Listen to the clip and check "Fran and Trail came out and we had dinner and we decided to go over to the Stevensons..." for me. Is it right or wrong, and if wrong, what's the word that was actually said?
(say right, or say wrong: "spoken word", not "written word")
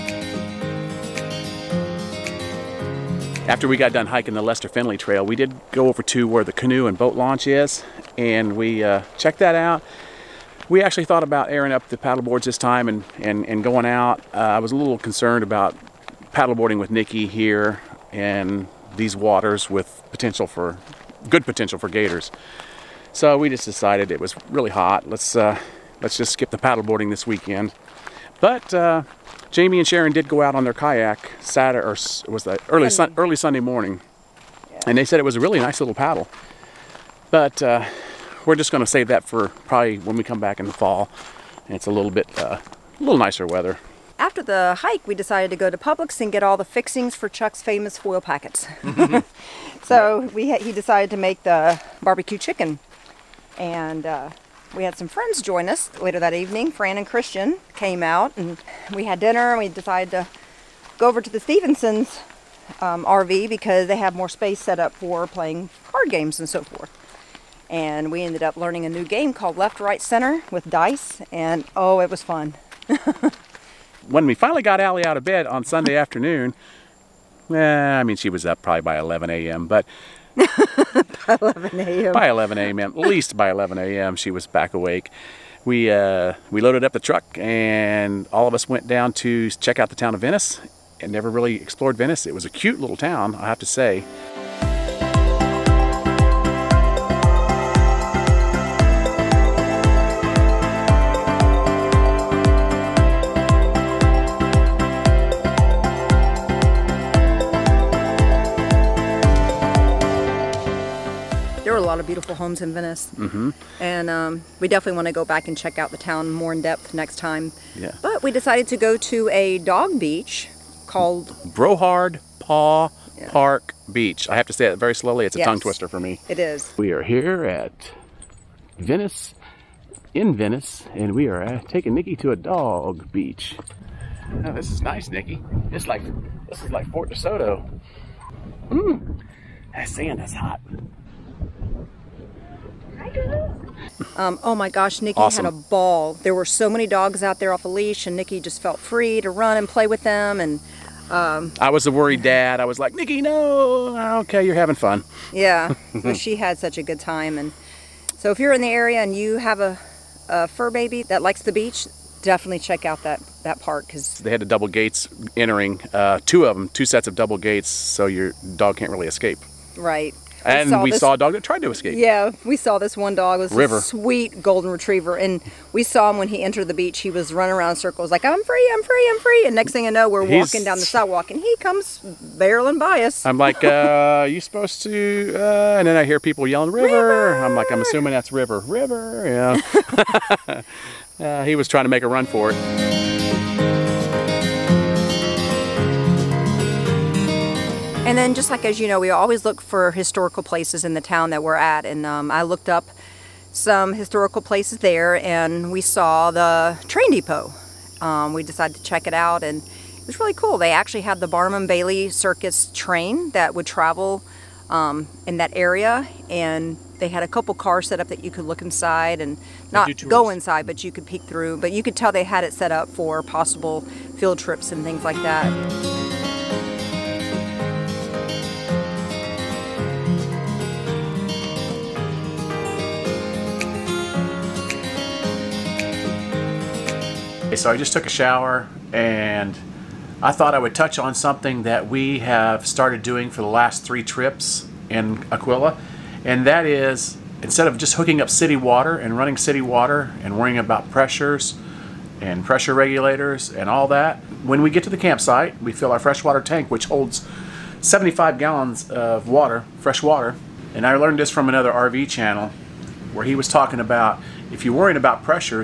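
wrong: "Christian", not "Trail".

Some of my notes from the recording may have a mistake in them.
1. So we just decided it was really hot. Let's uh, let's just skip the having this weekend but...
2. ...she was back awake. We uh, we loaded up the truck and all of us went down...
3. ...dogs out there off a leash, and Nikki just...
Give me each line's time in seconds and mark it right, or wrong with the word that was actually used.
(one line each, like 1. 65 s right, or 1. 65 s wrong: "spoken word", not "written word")
1. 23 s wrong: "paddleboarding", not "having"
2. 84 s right
3. 146 s right.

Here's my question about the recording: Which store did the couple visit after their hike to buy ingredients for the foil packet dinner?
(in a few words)
Publix.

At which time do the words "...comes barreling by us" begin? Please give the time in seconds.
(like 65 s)
181 s.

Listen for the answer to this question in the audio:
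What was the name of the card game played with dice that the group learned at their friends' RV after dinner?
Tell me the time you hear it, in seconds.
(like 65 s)
69 s.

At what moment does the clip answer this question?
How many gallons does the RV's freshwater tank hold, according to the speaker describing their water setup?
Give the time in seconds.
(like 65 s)
257 s.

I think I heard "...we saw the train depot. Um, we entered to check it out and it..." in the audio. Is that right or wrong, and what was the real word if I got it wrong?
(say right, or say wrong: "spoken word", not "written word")
wrong: "decided", not "entered".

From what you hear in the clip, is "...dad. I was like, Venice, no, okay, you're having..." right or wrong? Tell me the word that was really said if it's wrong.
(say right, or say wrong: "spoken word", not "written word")
wrong: "Nikki", not "Venice".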